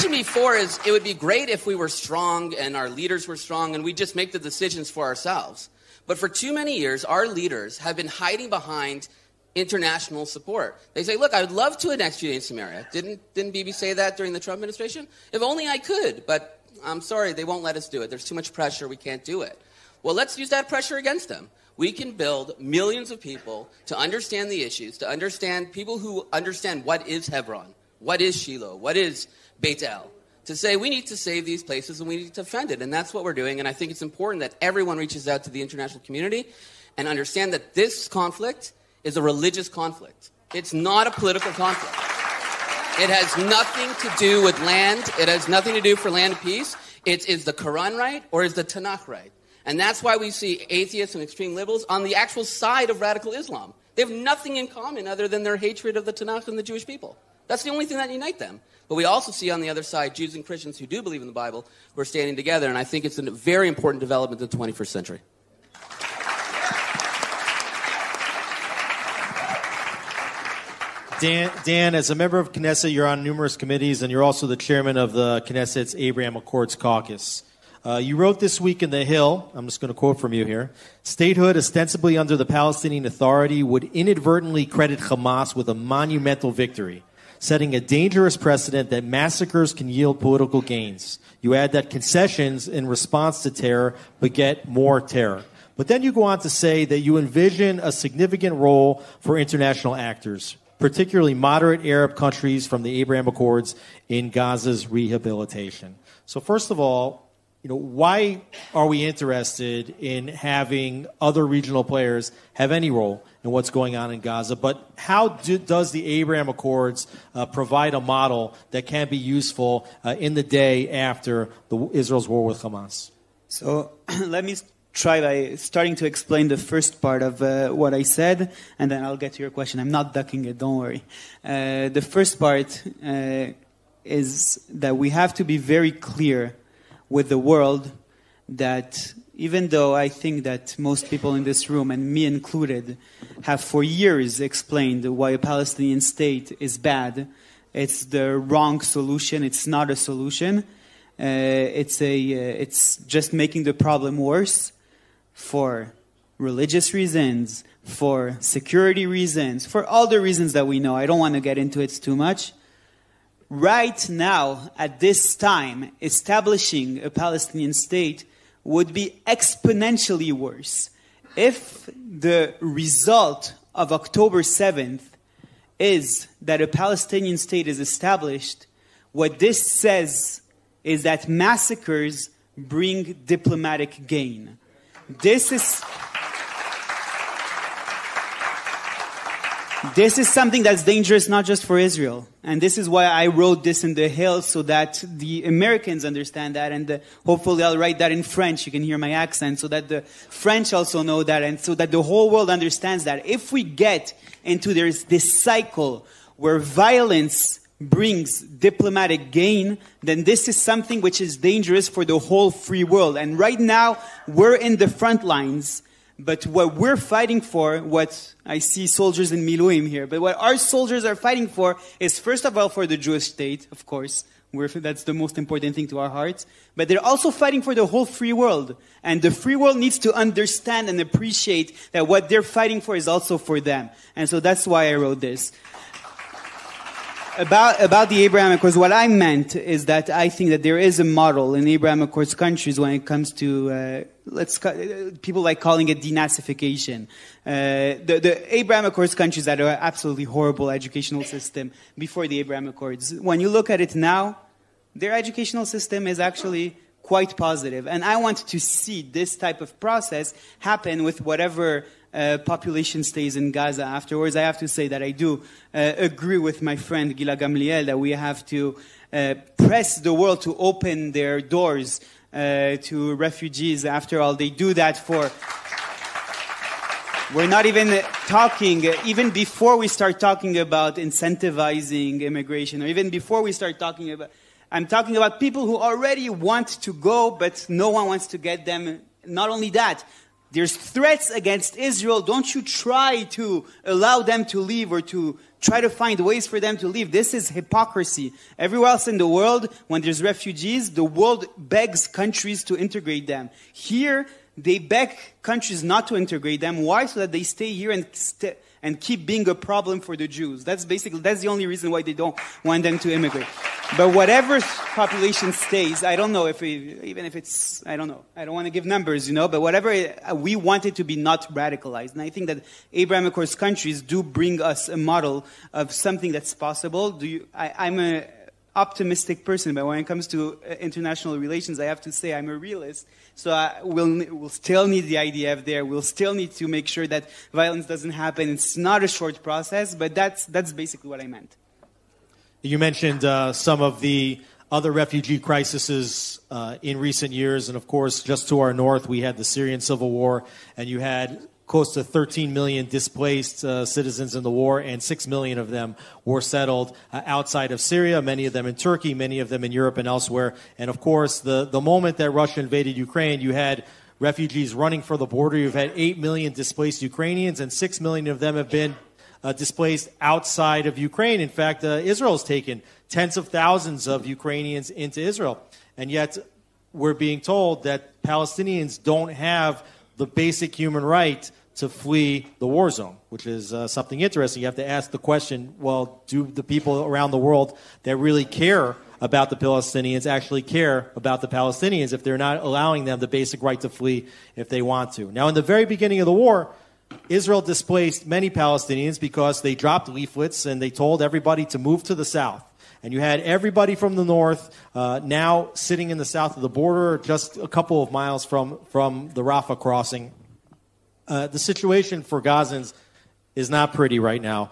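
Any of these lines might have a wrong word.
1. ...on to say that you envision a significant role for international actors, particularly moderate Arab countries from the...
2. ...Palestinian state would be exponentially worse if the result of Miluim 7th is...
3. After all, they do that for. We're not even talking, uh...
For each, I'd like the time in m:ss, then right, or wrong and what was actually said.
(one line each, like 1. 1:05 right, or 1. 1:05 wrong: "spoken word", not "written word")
1. 1:36 right
2. 2:47 wrong: "October", not "Miluim"
3. 4:33 right.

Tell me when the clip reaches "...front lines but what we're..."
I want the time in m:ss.
3:34.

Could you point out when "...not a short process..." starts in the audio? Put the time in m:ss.
5:38.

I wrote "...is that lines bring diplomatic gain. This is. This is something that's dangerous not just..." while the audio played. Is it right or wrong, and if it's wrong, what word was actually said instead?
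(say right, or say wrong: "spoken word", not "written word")
wrong: "massacres", not "lines".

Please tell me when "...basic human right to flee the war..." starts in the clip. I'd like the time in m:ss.
6:20.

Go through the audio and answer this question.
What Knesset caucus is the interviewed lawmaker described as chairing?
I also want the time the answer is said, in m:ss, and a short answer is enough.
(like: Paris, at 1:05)
Abraham Accords Caucus, at 1:15.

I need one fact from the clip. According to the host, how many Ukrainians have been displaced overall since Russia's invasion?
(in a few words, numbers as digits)
8 million.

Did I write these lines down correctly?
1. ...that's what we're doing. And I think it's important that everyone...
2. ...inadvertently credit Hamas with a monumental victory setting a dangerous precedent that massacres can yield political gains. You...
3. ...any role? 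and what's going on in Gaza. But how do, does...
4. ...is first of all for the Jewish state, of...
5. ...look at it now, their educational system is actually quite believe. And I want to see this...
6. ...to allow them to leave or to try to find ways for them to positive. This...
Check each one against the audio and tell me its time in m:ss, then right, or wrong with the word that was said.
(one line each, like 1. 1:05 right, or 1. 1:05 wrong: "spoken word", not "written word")
1. 0:32 right
2. 1:23 right
3. 1:52 right
4. 3:41 right
5. 4:13 wrong: "positive", not "believe"
6. 4:53 wrong: "leave", not "positive".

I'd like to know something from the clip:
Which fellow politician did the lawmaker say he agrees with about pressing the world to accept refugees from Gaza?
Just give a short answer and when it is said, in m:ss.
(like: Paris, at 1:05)
Gila Gamliel, at 4:27.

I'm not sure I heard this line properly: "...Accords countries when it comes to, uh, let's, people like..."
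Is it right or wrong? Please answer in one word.
right.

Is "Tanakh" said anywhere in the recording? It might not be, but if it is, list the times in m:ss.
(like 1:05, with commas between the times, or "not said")
0:48, 0:56.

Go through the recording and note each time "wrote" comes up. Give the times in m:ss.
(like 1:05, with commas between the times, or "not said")
1:18, 3:13, 3:54.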